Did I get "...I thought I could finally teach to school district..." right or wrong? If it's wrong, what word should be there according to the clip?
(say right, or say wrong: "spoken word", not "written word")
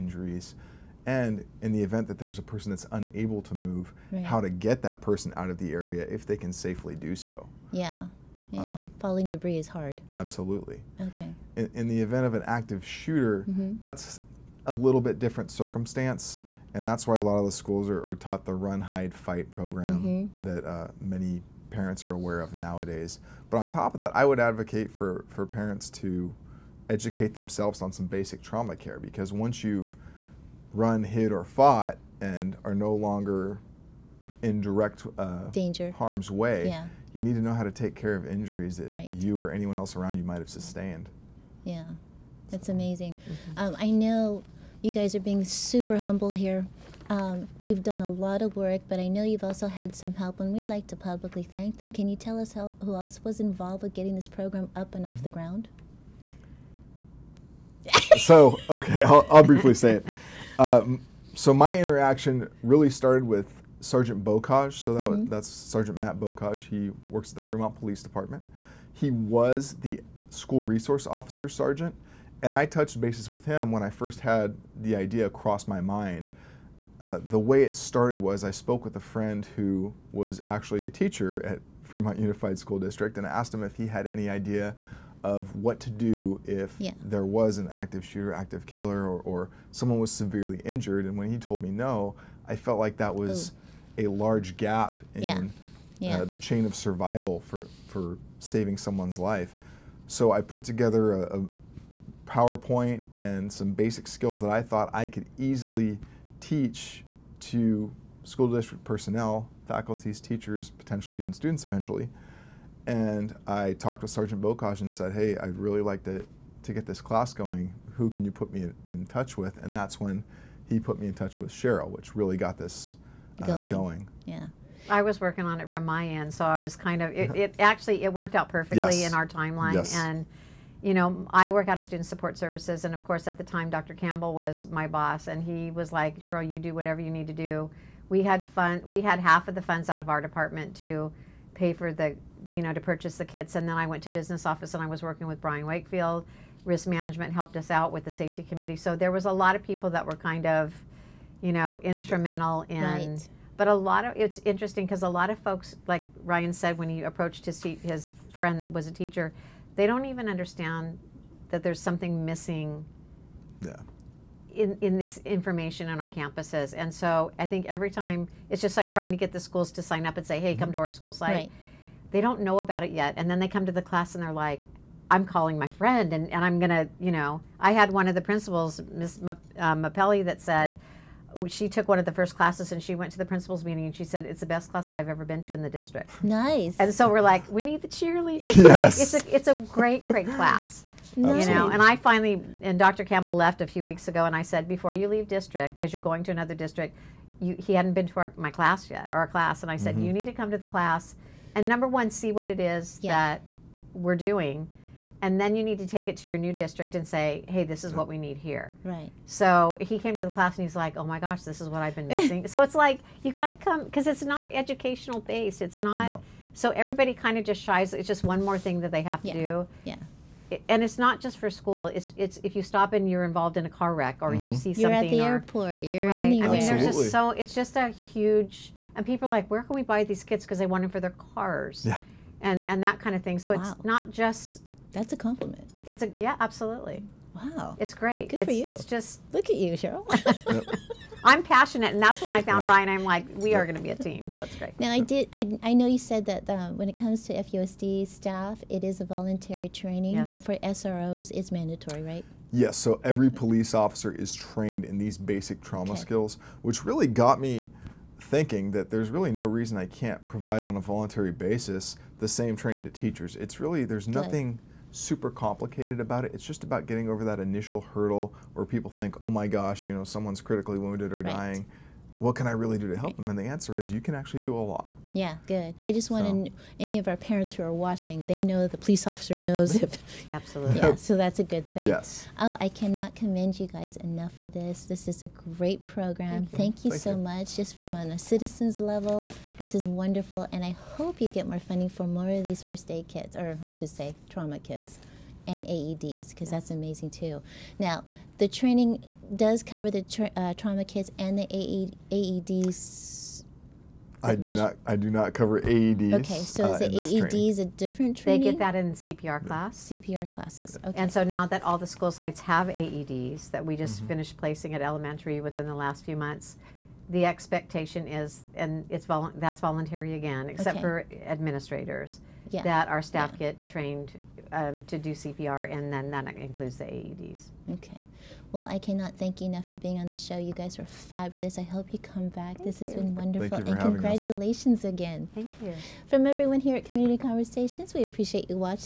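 wrong: "easily", not "finally".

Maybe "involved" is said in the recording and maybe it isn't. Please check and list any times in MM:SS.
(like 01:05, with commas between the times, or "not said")
00:53, 03:43.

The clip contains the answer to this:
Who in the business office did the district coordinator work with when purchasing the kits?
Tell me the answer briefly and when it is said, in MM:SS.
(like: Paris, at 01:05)
Brian Wakefield, at 02:25.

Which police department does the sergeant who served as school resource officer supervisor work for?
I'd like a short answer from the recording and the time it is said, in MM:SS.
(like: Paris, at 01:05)
Fremont Police Department, at 01:07.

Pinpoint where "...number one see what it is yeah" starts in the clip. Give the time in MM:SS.
03:21.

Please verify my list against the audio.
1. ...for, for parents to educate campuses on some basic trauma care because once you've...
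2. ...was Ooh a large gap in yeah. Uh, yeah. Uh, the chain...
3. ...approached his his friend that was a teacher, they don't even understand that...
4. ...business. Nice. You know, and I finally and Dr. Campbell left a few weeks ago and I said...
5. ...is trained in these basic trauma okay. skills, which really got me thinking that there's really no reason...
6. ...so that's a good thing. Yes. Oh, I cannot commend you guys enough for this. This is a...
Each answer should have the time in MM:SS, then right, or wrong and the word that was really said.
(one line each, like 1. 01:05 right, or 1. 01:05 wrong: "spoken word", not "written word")
1. 00:24 wrong: "themselves", not "campuses"
2. 01:33 right
3. 02:37 right
4. 03:10 wrong: "class", not "business"
5. 04:14 right
6. 04:40 right.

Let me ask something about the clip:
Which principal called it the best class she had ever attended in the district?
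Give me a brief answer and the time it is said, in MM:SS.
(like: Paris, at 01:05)
Ms. Mappelli, at 02:58.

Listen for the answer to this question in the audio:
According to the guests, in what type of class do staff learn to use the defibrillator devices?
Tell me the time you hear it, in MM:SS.
05:08.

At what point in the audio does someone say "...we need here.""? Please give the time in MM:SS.
03:28.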